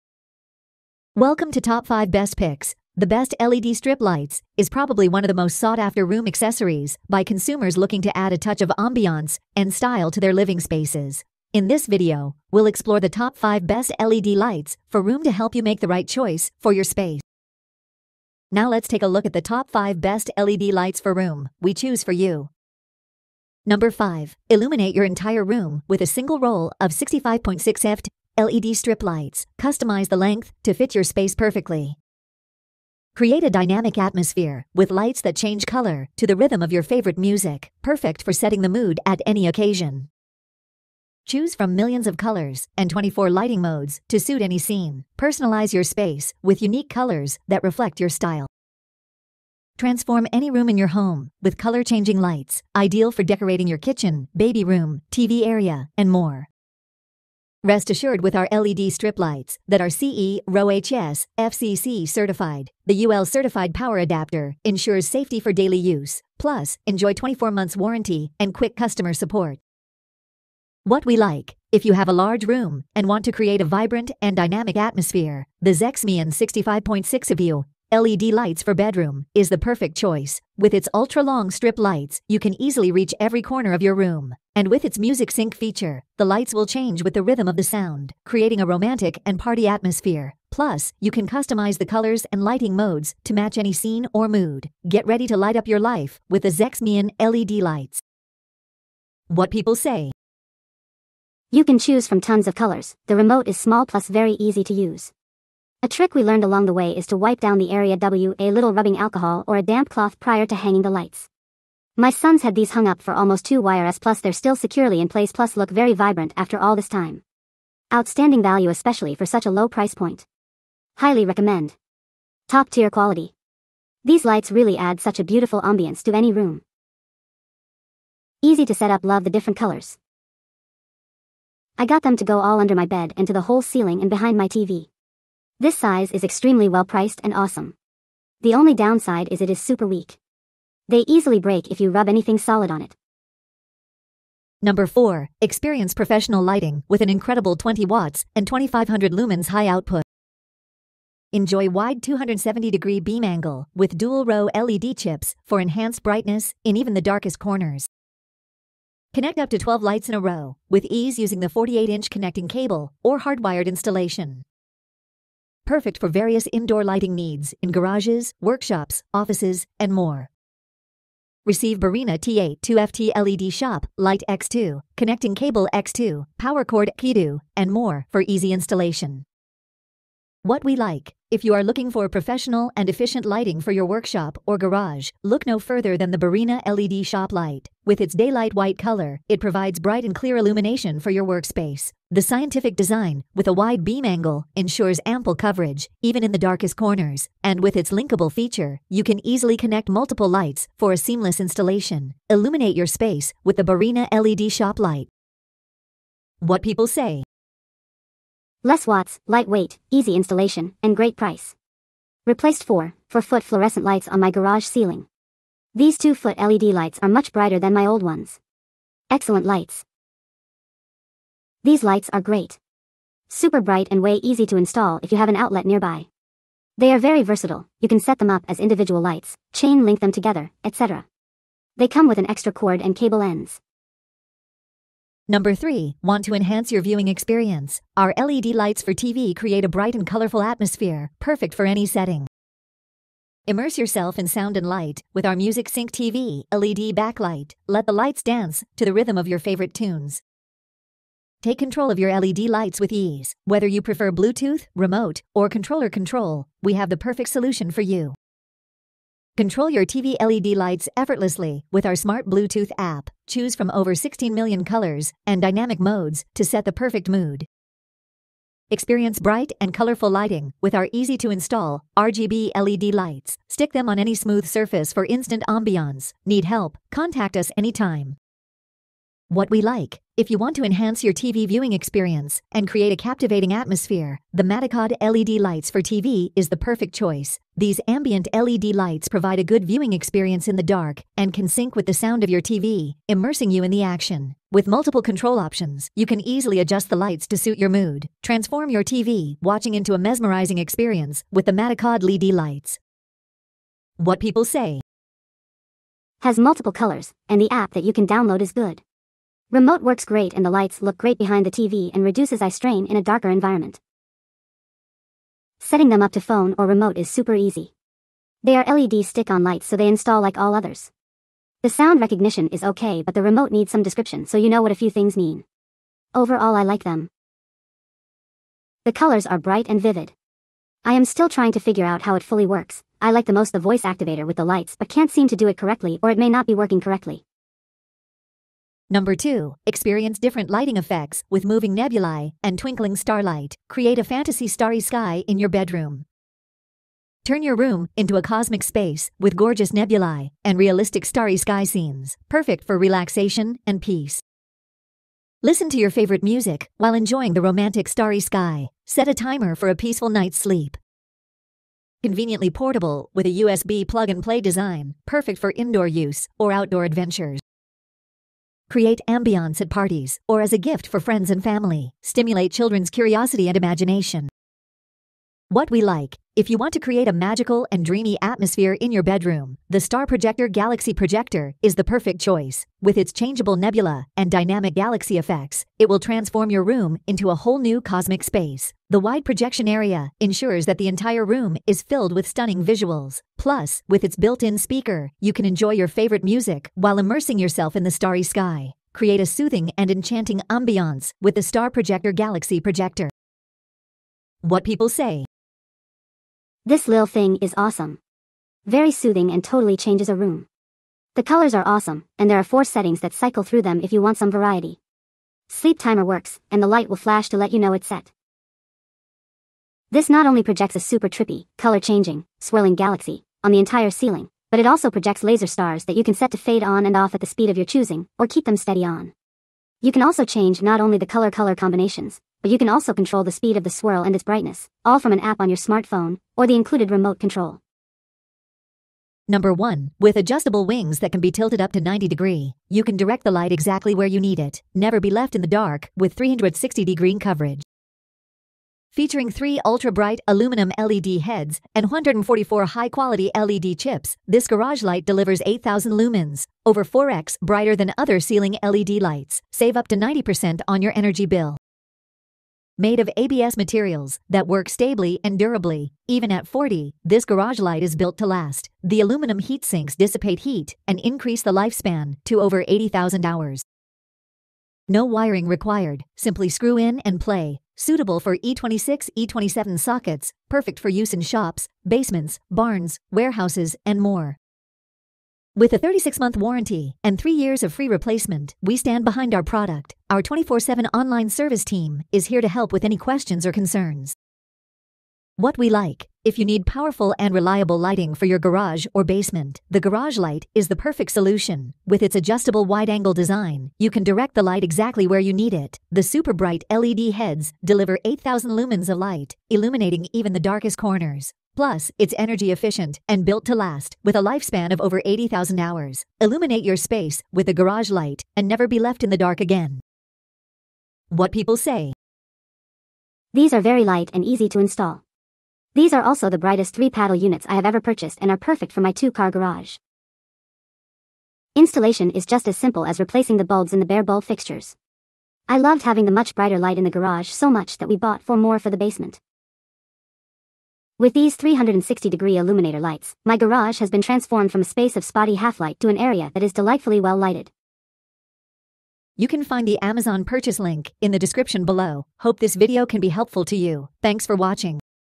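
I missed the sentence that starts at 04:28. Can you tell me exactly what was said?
Experience bright and colorful lighting with our easy-to-install RGB LED lights.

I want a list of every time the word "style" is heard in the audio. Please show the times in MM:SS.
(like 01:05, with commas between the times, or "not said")
00:09, 00:48.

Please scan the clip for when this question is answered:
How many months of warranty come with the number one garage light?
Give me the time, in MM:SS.
08:05.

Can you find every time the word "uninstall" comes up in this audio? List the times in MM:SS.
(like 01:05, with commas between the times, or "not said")
not said.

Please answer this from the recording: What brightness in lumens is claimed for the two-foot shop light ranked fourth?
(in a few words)
2500.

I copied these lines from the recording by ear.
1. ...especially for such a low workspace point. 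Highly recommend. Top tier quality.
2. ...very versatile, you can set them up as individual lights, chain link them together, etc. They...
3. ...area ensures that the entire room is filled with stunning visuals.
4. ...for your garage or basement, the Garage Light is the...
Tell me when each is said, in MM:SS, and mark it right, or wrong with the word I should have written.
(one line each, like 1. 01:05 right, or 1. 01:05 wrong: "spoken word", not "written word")
1. 01:58 wrong: "price", not "workspace"
2. 03:46 right
3. 06:29 right
4. 08:18 right.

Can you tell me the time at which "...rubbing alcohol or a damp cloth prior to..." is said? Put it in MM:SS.
01:48.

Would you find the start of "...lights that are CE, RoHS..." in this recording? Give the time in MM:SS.
00:59.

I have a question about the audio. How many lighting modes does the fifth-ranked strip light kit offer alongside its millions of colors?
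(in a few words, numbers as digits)
24.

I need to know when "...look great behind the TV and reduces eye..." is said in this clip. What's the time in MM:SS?
05:10.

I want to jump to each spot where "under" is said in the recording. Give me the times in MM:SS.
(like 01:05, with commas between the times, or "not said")
02:12.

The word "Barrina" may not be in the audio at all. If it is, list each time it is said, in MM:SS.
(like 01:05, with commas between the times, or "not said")
02:51, 03:06, 03:23.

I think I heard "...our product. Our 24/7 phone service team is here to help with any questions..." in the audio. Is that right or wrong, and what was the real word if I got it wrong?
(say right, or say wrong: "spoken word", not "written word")
wrong: "online", not "phone".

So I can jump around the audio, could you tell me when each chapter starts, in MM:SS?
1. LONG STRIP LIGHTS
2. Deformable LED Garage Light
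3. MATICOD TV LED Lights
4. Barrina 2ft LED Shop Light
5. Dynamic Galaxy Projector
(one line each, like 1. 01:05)
1. 00:22
2. 07:18
3. 03:54
4. 02:23
5. 05:37.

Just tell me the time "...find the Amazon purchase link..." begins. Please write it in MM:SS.
09:09.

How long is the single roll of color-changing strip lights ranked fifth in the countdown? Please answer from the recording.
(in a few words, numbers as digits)
65.6 ft.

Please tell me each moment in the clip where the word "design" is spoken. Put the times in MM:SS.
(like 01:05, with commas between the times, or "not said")
03:12, 06:04, 08:23.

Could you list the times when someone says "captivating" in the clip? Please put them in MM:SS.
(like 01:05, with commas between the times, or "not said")
04:43.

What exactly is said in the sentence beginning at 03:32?
Replaced 4, 4-foot fluorescent lights on my garage ceiling.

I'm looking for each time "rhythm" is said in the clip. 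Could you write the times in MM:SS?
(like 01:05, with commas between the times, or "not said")
00:36, 01:27, 04:08.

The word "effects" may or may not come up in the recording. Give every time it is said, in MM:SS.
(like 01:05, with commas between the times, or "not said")
05:40, 06:25.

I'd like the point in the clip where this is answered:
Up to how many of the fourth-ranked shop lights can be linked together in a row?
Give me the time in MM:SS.
02:39.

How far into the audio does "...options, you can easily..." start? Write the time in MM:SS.
04:55.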